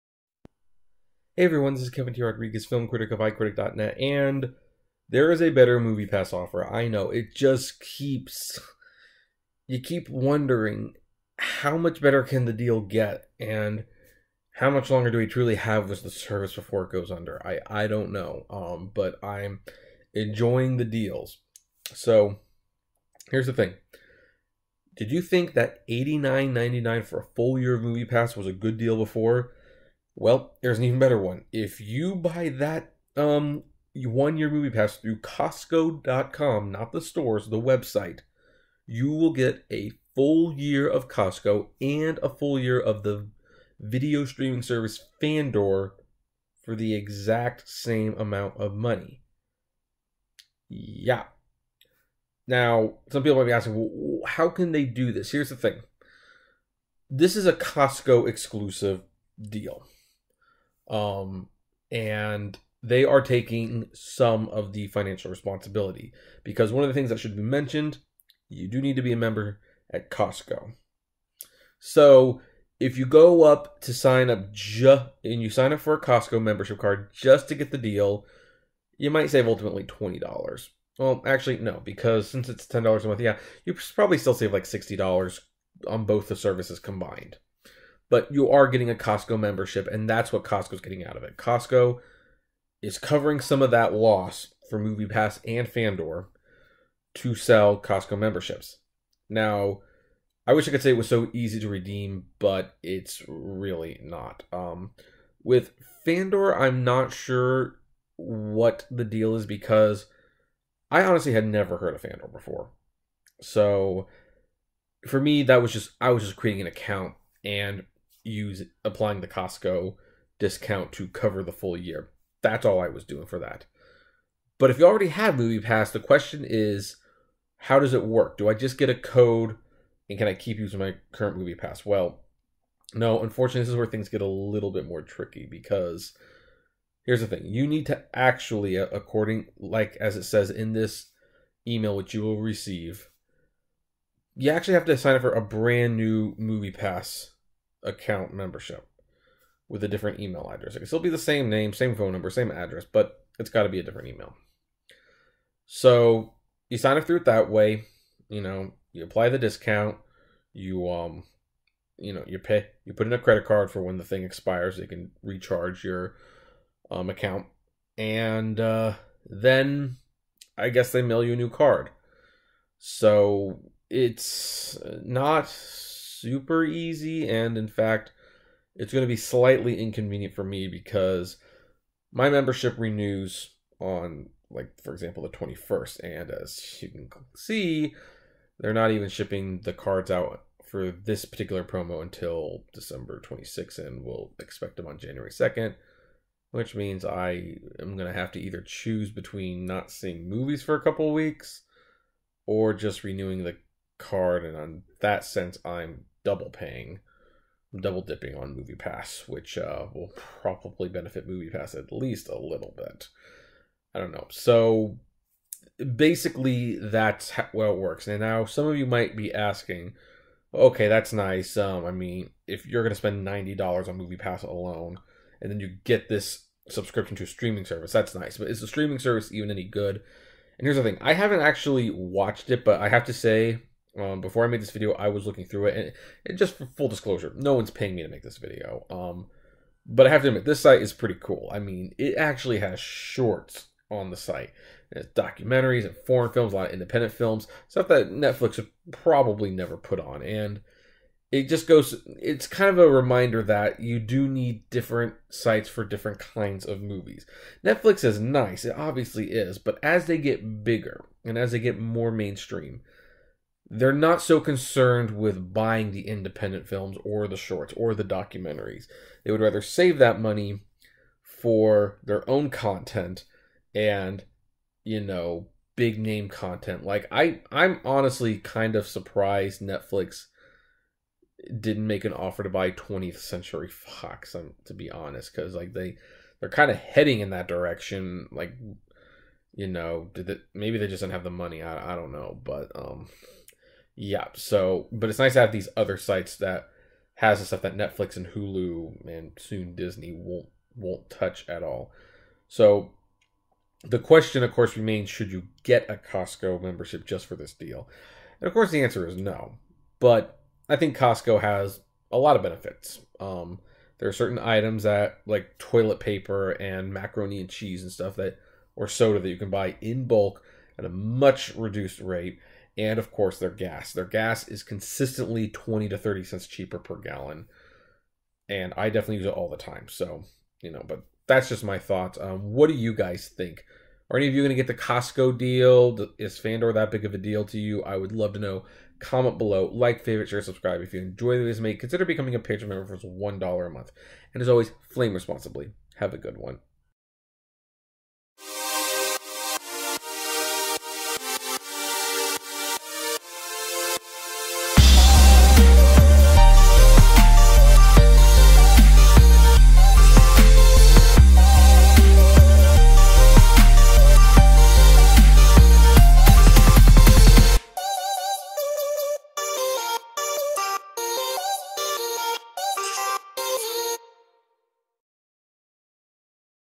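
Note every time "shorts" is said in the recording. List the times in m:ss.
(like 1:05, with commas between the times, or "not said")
4:02, 4:27.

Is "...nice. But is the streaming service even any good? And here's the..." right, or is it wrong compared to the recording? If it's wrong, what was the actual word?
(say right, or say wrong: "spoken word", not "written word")
right.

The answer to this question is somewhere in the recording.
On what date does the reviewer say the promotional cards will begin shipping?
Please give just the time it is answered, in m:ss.
3:12.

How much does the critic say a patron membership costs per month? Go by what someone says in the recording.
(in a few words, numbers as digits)
$1.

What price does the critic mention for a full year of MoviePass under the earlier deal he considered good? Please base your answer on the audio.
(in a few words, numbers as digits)
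$89.99.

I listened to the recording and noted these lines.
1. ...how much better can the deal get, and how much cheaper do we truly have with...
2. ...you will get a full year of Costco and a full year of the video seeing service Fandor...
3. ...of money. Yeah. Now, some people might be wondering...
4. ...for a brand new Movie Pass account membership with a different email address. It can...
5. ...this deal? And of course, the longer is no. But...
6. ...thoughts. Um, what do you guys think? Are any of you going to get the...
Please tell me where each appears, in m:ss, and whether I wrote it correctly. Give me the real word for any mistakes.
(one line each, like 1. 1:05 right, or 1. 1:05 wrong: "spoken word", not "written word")
1. 0:11 wrong: "longer", not "cheaper"
2. 0:38 wrong: "streaming", not "seeing"
3. 0:48 wrong: "asking", not "wondering"
4. 2:25 right
5. 5:07 wrong: "answer", not "longer"
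6. 5:31 right.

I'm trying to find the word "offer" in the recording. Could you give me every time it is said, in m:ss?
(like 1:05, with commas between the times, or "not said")
0:06, 4:42.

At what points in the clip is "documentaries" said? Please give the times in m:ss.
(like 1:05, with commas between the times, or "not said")
4:05, 4:28.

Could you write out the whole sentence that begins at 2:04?
But if you already have Movie Pass, the question is, how does it work?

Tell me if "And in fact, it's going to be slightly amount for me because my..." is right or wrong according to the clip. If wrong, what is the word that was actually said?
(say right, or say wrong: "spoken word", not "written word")
wrong: "inconvenient", not "amount".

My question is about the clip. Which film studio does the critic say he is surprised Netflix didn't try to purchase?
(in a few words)
20th Century Fox.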